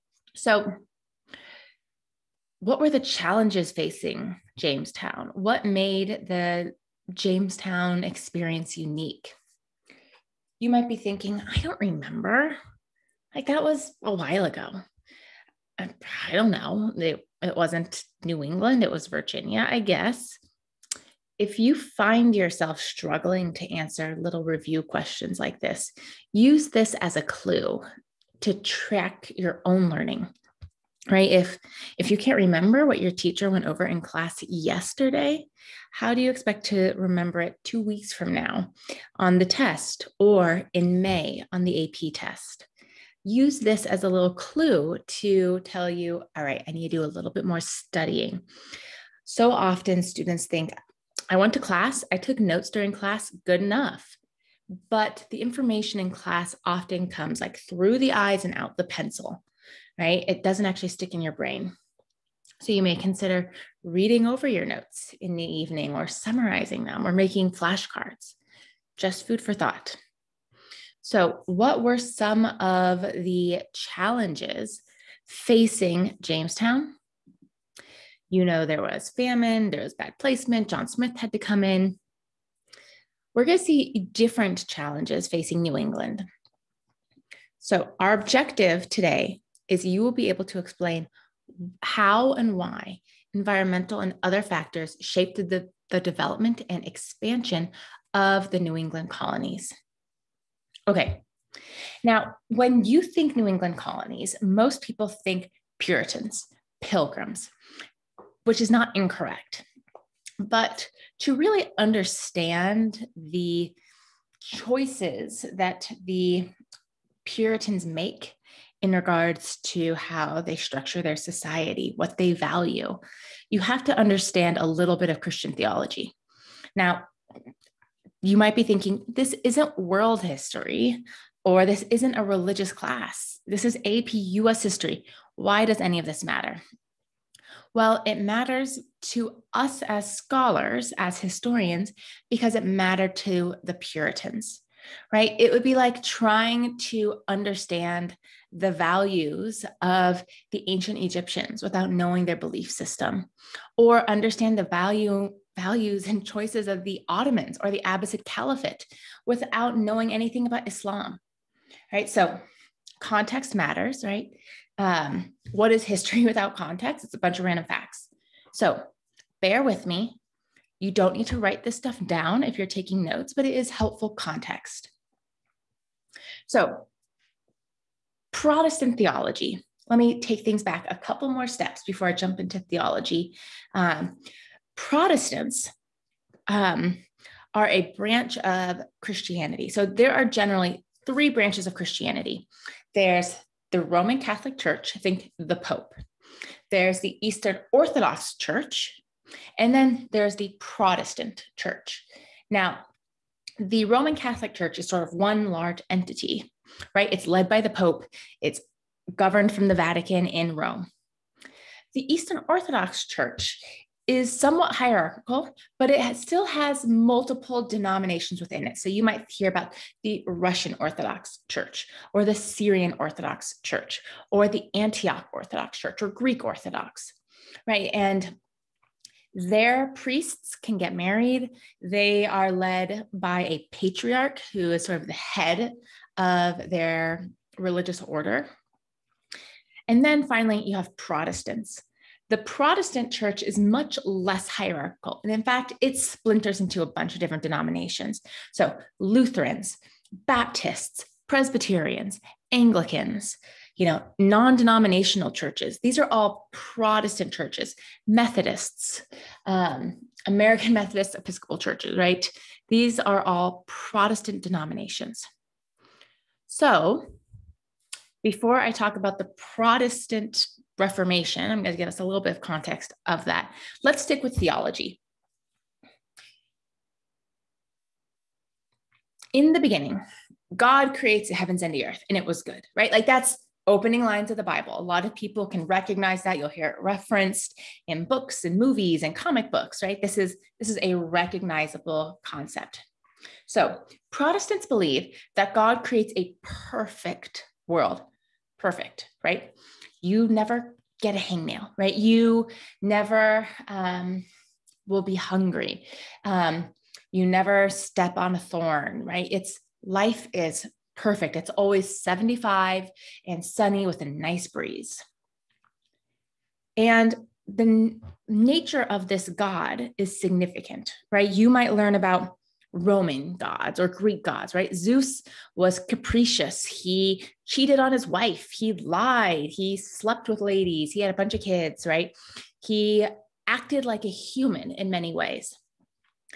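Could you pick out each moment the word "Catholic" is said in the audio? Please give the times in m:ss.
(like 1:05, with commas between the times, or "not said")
3:14, 3:24.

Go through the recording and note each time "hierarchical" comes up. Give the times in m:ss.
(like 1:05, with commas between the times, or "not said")
3:34, 4:04.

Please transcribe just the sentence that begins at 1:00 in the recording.
It doesn't actually stick in your brain.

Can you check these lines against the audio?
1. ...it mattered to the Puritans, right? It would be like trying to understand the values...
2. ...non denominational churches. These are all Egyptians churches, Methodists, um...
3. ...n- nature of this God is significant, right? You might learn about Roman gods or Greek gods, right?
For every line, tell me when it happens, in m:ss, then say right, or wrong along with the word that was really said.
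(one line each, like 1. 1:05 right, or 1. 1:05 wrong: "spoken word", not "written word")
1. 2:22 right
2. 4:14 wrong: "Protestant", not "Egyptians"
3. 5:17 right.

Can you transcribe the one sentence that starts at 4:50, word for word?
This is this is a recognizable concept.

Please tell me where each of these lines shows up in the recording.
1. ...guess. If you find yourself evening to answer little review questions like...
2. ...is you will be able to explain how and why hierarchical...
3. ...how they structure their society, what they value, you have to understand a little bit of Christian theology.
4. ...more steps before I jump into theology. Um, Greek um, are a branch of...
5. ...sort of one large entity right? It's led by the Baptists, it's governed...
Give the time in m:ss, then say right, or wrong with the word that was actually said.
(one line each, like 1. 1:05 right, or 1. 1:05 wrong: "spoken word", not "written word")
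1. 0:19 wrong: "struggling", not "evening"
2. 1:29 wrong: "environmental", not "hierarchical"
3. 1:59 right
4. 3:01 wrong: "Protestants", not "Greek"
5. 3:24 wrong: "Pope", not "Baptists".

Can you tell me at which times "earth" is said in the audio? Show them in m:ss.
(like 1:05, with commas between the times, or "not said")
4:41.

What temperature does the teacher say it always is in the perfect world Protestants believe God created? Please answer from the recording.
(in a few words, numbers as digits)
75.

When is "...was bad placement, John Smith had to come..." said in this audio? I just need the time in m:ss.
1:19.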